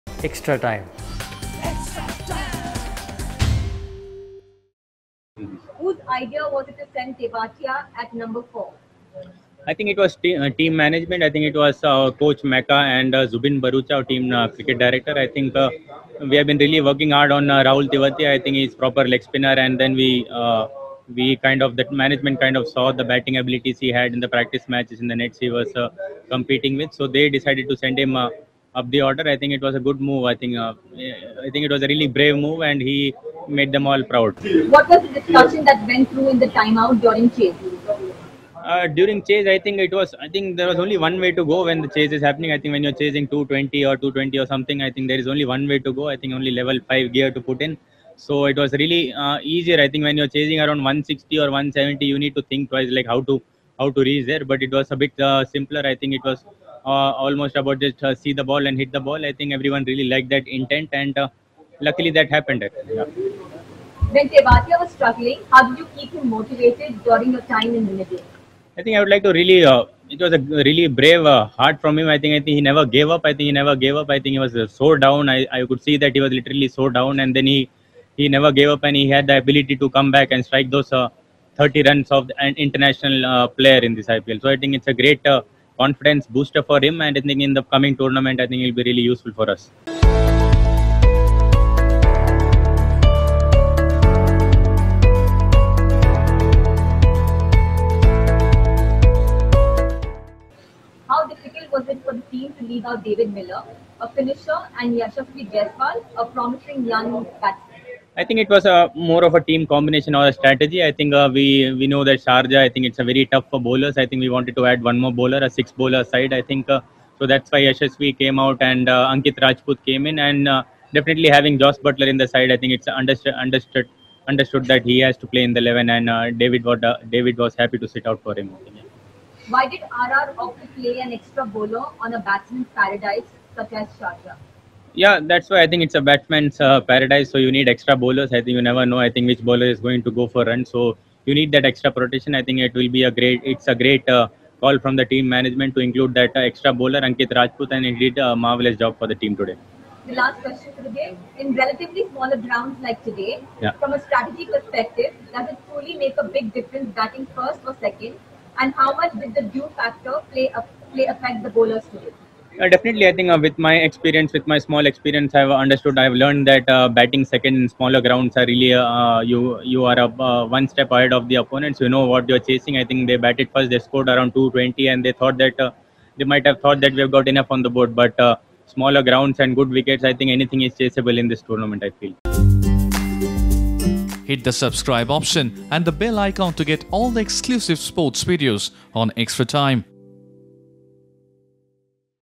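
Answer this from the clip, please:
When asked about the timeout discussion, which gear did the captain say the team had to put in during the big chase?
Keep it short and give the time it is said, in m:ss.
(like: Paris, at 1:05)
level five, at 0:46.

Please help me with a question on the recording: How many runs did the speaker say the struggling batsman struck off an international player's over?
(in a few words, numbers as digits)
30.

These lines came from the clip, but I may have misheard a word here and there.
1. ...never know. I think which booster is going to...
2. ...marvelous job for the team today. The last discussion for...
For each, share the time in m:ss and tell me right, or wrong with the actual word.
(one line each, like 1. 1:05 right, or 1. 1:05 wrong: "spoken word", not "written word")
1. 2:18 wrong: "bowler", not "booster"
2. 2:28 wrong: "question", not "discussion".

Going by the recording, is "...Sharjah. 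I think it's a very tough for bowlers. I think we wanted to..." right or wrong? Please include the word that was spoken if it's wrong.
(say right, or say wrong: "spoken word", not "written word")
right.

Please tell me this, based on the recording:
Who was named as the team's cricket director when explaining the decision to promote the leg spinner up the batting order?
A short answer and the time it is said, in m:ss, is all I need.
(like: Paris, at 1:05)
Zubin Bharucha, at 0:13.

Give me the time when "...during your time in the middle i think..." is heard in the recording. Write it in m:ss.
1:07.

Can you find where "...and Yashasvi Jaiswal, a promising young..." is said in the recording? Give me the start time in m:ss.
1:44.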